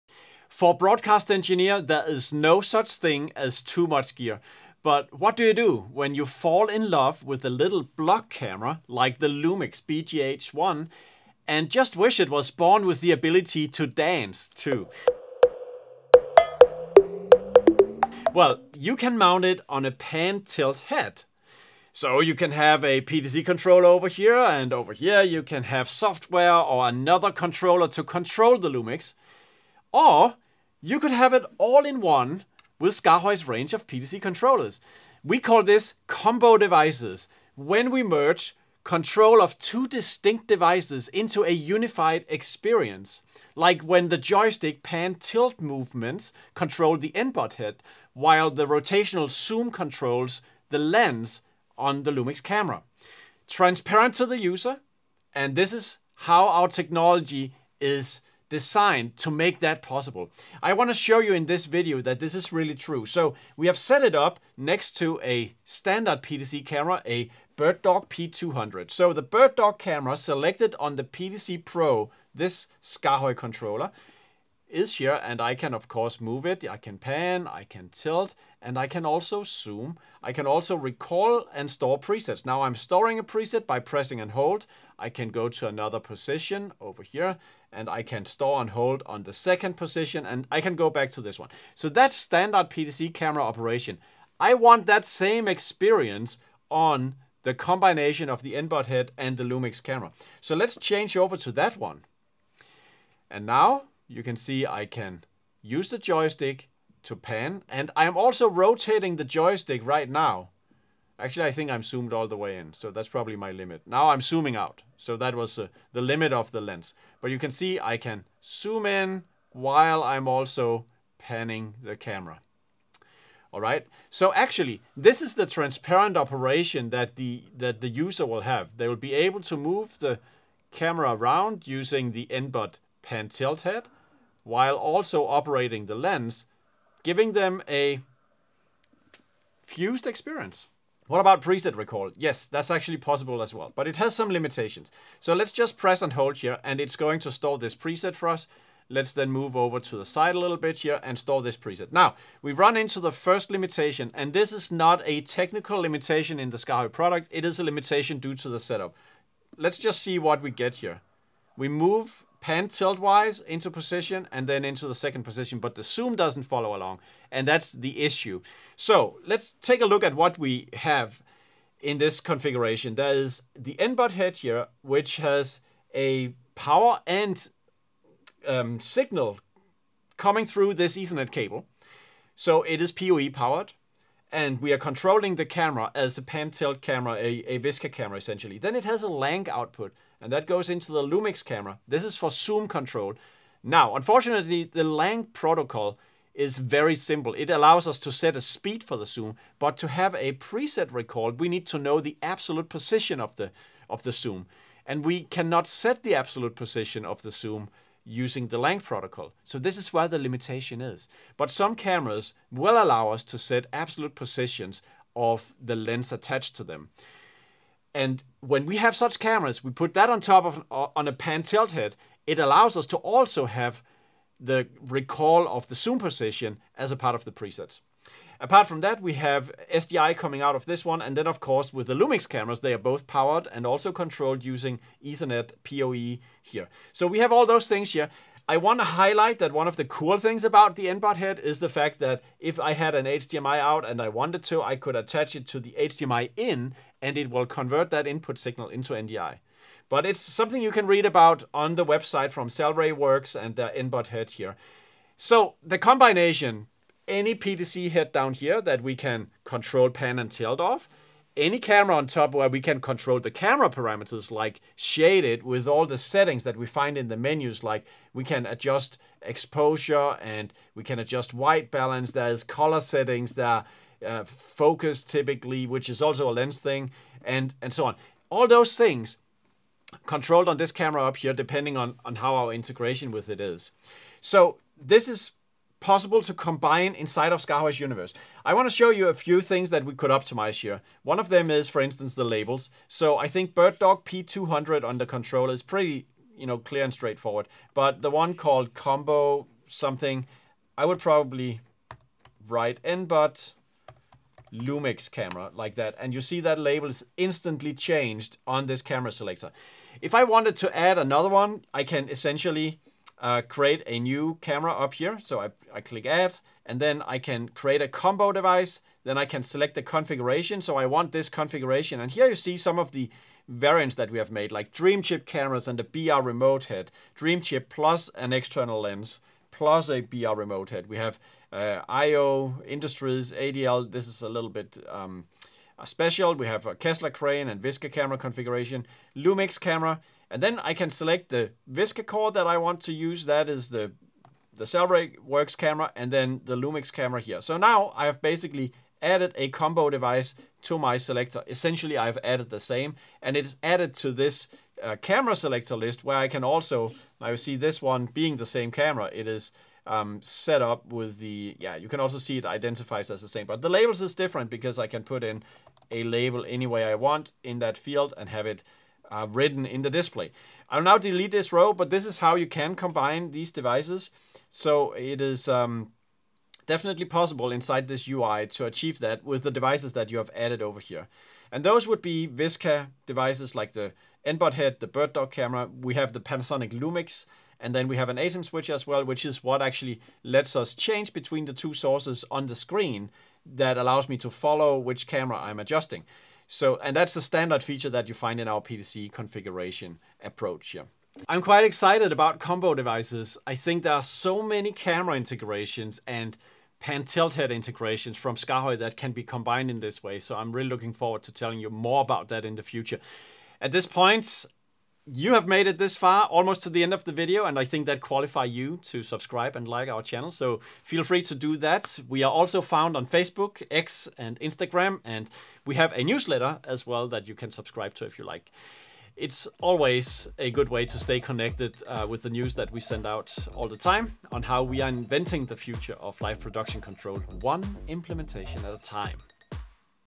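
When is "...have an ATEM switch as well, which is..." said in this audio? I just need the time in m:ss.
6:27.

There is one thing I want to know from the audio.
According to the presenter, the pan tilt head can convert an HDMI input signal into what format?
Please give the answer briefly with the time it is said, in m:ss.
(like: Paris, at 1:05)
NDI, at 4:08.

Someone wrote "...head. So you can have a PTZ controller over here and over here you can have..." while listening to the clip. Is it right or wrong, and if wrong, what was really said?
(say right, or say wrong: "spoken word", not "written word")
right.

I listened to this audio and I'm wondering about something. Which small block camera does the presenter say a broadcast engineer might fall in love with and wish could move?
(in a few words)
Lumix BGH1.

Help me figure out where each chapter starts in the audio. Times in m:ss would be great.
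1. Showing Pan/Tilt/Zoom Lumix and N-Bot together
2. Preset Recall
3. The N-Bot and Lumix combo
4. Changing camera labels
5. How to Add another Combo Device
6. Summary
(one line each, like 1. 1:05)
1. 1:40
2. 2:20
3. 2:53
4. 4:48
5. 5:10
6. 6:40.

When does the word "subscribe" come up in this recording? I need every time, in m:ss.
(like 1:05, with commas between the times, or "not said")
6:59, 7:07.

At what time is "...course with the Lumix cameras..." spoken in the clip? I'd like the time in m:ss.
3:51.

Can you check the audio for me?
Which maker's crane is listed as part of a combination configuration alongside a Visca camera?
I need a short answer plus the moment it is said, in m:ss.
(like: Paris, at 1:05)
Kessler, at 5:36.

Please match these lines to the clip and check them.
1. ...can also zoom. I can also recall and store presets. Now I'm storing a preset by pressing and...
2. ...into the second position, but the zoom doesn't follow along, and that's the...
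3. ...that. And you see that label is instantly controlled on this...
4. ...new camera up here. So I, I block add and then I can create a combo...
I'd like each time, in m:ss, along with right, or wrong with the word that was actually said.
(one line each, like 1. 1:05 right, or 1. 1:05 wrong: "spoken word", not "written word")
1. 1:18 right
2. 2:44 right
3. 5:05 wrong: "changed", not "controlled"
4. 5:13 wrong: "click", not "block".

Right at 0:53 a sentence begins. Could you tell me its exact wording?
Transparent to the user, and this is how our technology is designed to make that possible.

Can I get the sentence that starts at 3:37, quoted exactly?
And when we have such cameras, we put that on top of uh, on a pan tilt head.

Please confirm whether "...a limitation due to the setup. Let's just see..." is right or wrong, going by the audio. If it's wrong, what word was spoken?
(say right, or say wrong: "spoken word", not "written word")
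right.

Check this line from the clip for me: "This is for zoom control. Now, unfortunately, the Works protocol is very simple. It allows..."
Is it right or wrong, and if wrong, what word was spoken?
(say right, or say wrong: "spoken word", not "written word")
wrong: "LANC", not "Works".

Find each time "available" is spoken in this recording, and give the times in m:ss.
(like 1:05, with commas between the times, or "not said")
not said.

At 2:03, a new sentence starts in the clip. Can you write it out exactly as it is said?
All right, so actually, this is the transparent operation that the, that the user will have.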